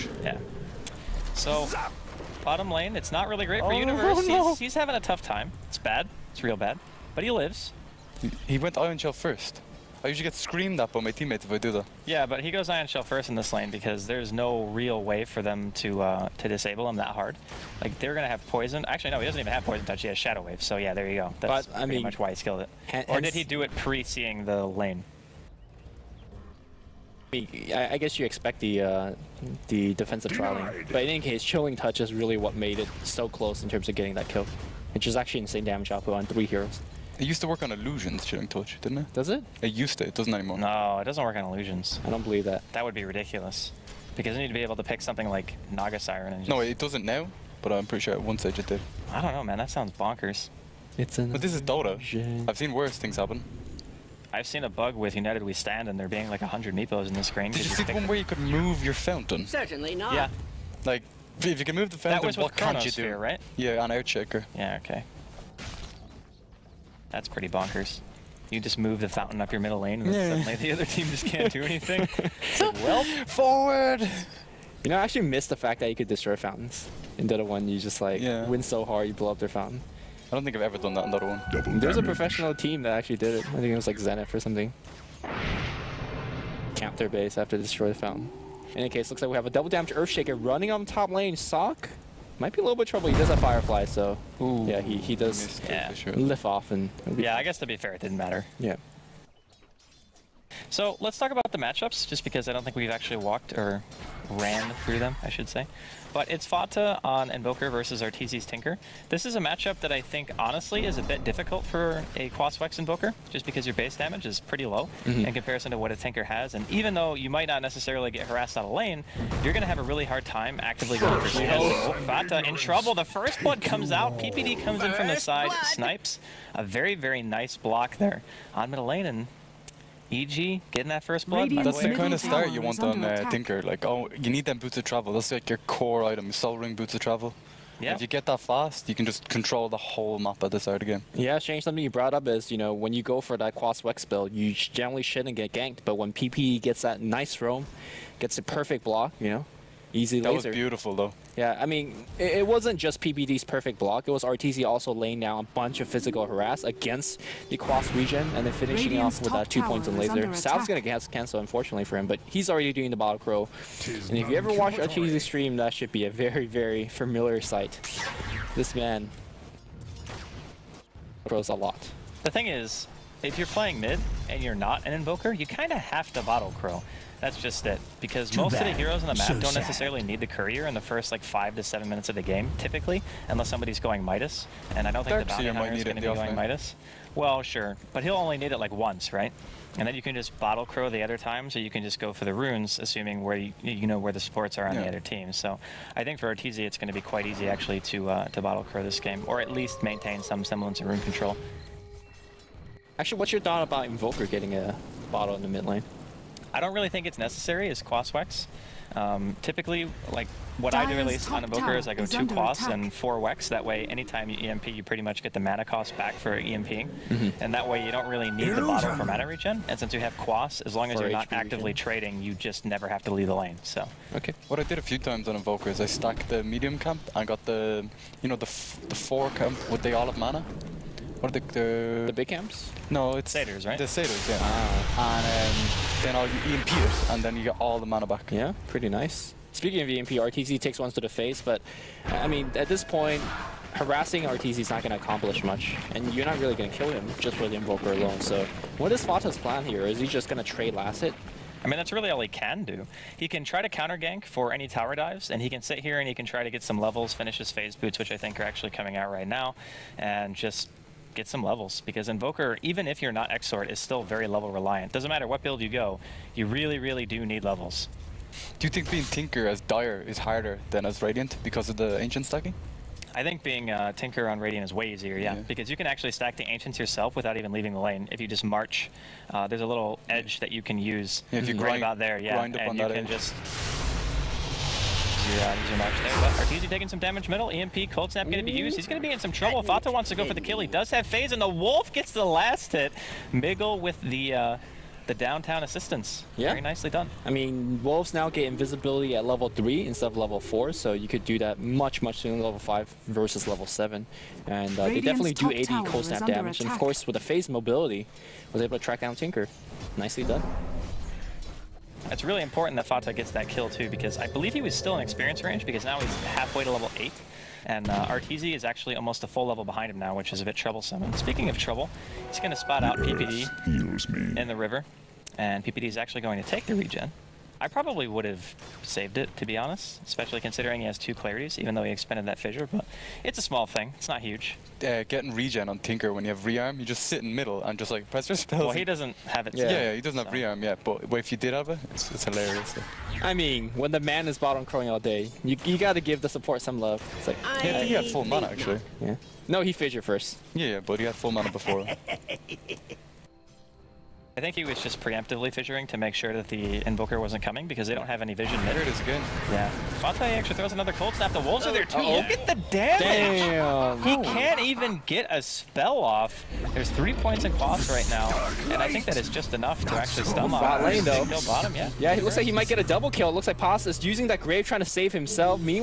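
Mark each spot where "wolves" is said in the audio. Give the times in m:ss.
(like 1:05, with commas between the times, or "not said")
4:57, 6:01.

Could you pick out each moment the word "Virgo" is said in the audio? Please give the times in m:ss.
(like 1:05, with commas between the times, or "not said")
not said.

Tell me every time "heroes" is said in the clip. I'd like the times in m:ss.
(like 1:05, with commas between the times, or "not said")
0:36, 2:58.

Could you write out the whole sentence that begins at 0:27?
I guess you expect the uh, the defensive trolling.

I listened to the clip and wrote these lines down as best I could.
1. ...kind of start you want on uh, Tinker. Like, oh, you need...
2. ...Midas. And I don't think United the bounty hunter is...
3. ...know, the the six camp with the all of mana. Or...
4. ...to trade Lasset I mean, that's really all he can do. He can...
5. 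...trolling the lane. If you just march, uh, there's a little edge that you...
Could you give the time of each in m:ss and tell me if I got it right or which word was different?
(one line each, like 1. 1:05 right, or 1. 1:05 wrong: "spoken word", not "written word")
1. 2:11 right
2. 3:04 wrong: "Dark", not "United"
3. 3:48 wrong: "four", not "six"
4. 4:10 right
5. 4:37 wrong: "leaving", not "trolling".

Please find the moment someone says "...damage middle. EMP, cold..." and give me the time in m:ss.
4:46.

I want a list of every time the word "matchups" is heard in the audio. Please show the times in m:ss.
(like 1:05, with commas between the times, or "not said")
1:41, 1:49.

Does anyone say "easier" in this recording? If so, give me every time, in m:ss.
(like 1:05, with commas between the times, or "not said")
4:34.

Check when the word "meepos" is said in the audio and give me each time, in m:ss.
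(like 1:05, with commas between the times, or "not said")
0:56.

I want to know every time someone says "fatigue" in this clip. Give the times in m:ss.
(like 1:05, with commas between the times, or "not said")
not said.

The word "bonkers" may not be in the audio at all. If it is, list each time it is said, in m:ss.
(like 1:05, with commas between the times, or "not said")
0:49, 1:07.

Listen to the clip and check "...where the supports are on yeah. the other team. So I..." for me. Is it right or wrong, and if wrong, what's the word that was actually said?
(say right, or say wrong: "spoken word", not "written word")
right.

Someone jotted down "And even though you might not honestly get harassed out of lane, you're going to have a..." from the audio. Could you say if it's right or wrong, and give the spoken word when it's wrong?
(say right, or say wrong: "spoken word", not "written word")
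wrong: "necessarily", not "honestly".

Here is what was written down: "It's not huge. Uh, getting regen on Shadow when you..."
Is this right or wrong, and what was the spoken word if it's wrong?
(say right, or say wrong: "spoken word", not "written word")
wrong: "Tinker", not "Shadow".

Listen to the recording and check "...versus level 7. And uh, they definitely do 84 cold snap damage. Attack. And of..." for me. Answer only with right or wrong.
wrong.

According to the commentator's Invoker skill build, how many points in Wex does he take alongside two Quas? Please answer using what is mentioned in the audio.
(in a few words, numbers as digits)
4.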